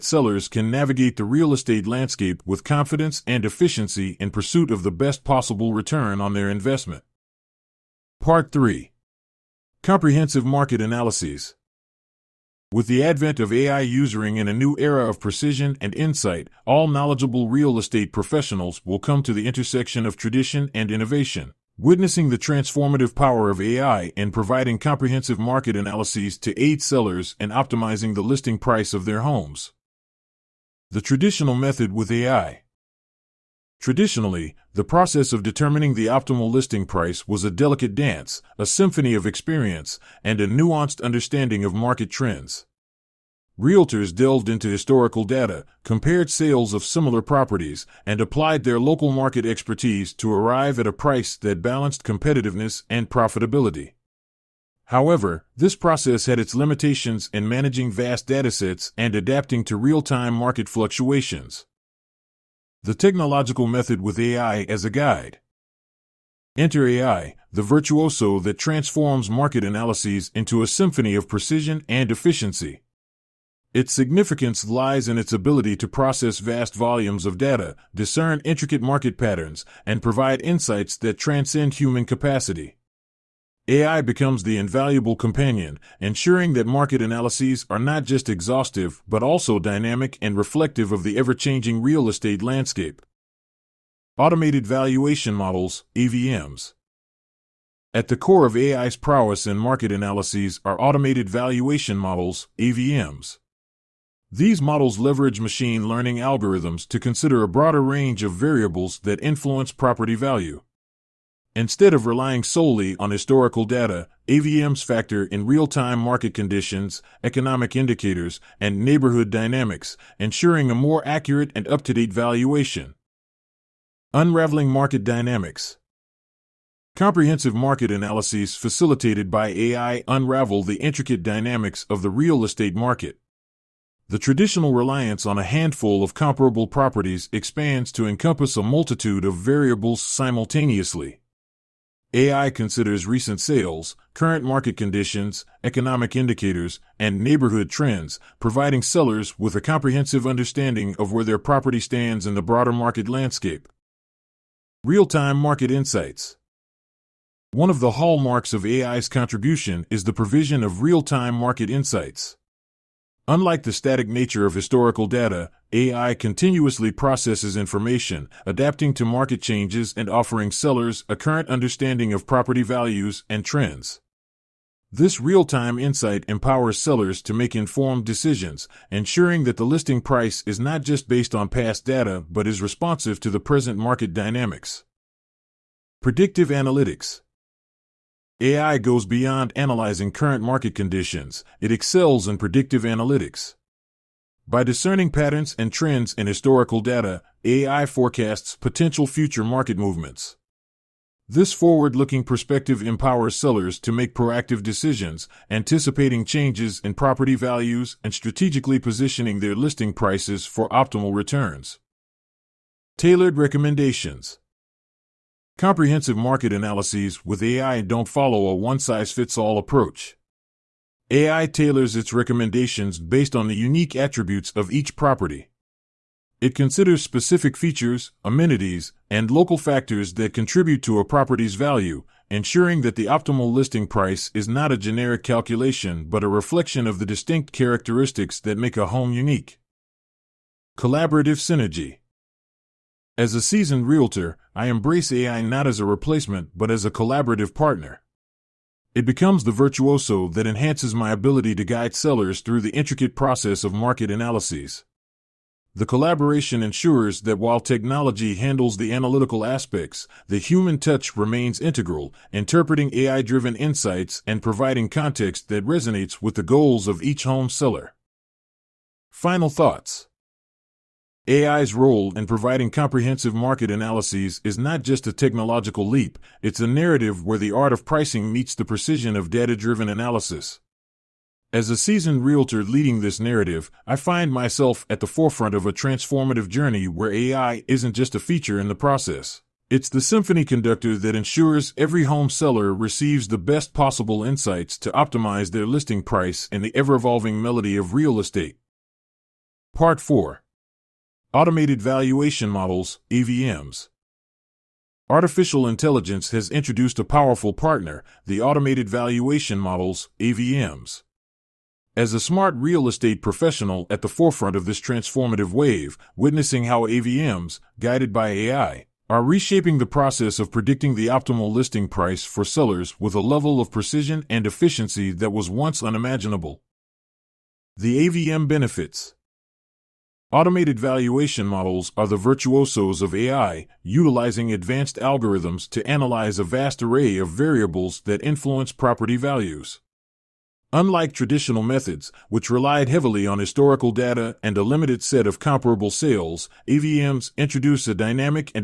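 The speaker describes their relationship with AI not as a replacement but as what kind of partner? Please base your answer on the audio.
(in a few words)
Collaborative partner.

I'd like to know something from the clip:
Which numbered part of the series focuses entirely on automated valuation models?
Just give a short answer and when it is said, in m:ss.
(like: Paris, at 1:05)
Part 4, at 4:59.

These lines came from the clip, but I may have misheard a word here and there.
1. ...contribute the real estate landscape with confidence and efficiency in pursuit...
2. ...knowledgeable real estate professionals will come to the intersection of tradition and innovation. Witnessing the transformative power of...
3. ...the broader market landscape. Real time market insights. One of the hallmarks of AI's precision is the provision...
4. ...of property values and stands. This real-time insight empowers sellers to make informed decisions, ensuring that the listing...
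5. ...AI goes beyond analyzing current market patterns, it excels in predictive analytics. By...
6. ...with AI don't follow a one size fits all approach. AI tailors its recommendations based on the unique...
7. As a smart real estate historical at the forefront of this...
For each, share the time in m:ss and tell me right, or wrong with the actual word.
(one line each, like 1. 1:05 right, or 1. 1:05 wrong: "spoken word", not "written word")
1. 0:00 wrong: "navigate", not "contribute"
2. 0:16 right
3. 2:32 wrong: "contribution", not "precision"
4. 2:52 wrong: "trends", not "stands"
5. 3:08 wrong: "conditions", not "patterns"
6. 3:37 right
7. 5:11 wrong: "professional", not "historical".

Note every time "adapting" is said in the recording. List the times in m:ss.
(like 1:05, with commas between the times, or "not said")
0:59, 2:48.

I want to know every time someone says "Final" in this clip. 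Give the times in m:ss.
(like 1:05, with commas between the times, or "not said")
4:29.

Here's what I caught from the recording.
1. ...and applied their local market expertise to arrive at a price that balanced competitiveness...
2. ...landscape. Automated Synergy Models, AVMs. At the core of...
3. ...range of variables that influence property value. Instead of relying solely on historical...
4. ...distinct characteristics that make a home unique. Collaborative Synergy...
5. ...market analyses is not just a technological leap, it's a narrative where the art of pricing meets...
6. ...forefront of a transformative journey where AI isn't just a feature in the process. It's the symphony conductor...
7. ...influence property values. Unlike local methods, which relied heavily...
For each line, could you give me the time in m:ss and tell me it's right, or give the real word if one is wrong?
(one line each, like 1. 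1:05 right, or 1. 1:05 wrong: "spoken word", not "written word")
1. 0:48 right
2. 1:32 wrong: "Valuation", not "Synergy"
3. 1:47 right
4. 3:57 right
5. 4:33 right
6. 4:45 right
7. 5:38 wrong: "traditional", not "local".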